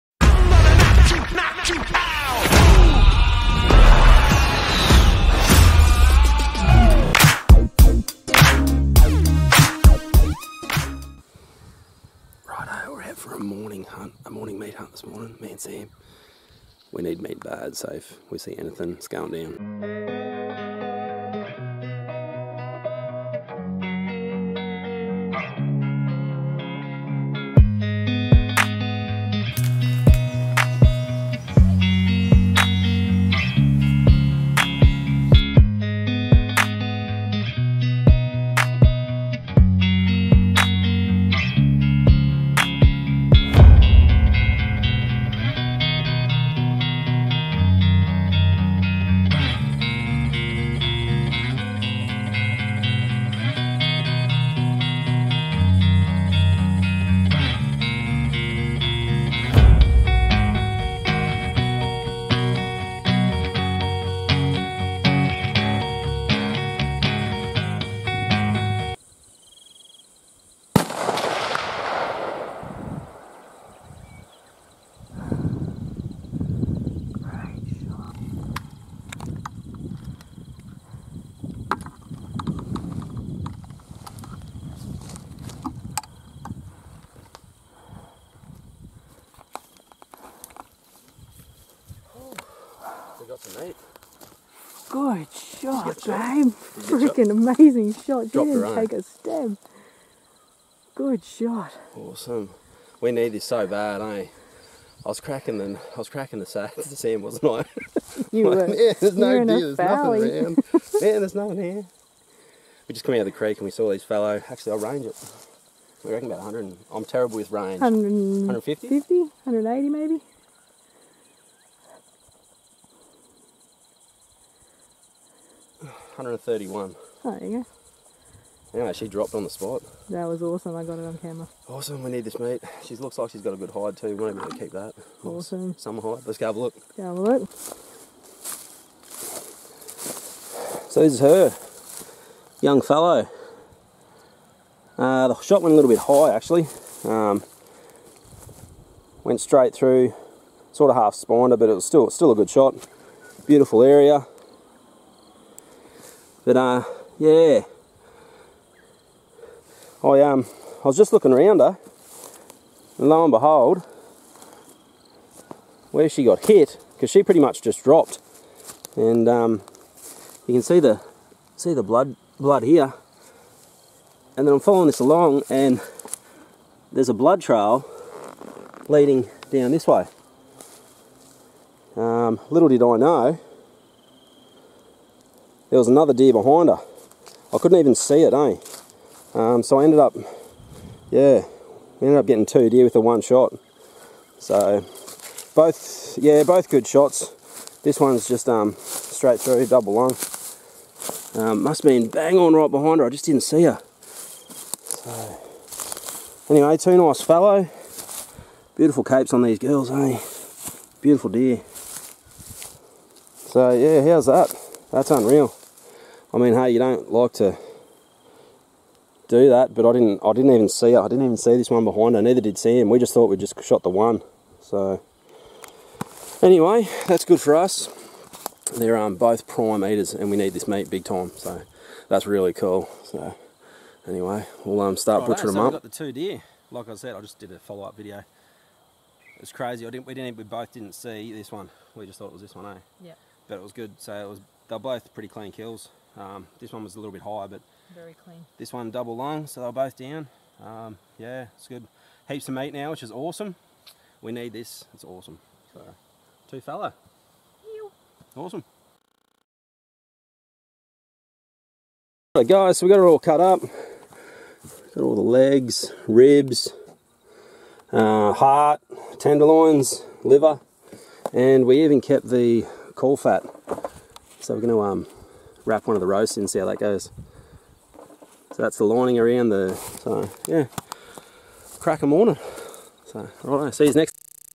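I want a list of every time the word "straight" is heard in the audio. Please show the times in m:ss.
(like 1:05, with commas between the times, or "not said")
2:29, 3:18.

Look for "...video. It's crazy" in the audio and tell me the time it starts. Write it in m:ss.
3:57.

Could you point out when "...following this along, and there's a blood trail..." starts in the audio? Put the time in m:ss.
2:54.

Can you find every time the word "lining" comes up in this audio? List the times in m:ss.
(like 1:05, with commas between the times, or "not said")
4:38.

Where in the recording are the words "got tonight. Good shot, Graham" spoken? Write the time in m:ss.
1:33.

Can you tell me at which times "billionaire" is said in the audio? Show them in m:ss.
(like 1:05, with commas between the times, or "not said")
not said.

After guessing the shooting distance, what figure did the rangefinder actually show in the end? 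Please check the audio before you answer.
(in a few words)
131.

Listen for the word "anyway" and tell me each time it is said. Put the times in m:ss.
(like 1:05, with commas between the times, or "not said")
2:08, 3:26, 3:46, 3:54.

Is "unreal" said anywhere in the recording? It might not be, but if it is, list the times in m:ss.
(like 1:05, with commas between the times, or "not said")
3:35.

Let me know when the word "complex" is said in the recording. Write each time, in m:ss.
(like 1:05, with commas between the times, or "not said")
not said.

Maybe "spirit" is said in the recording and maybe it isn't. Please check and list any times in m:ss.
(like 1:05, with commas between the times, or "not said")
not said.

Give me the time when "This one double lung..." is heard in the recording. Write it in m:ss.
4:08.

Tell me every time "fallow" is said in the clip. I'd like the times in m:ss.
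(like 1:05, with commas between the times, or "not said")
1:54, 2:22, 3:27.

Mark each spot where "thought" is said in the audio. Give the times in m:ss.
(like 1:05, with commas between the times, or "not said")
3:43, 4:02.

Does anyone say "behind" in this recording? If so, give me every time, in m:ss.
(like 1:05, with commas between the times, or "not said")
3:06, 3:22, 3:41.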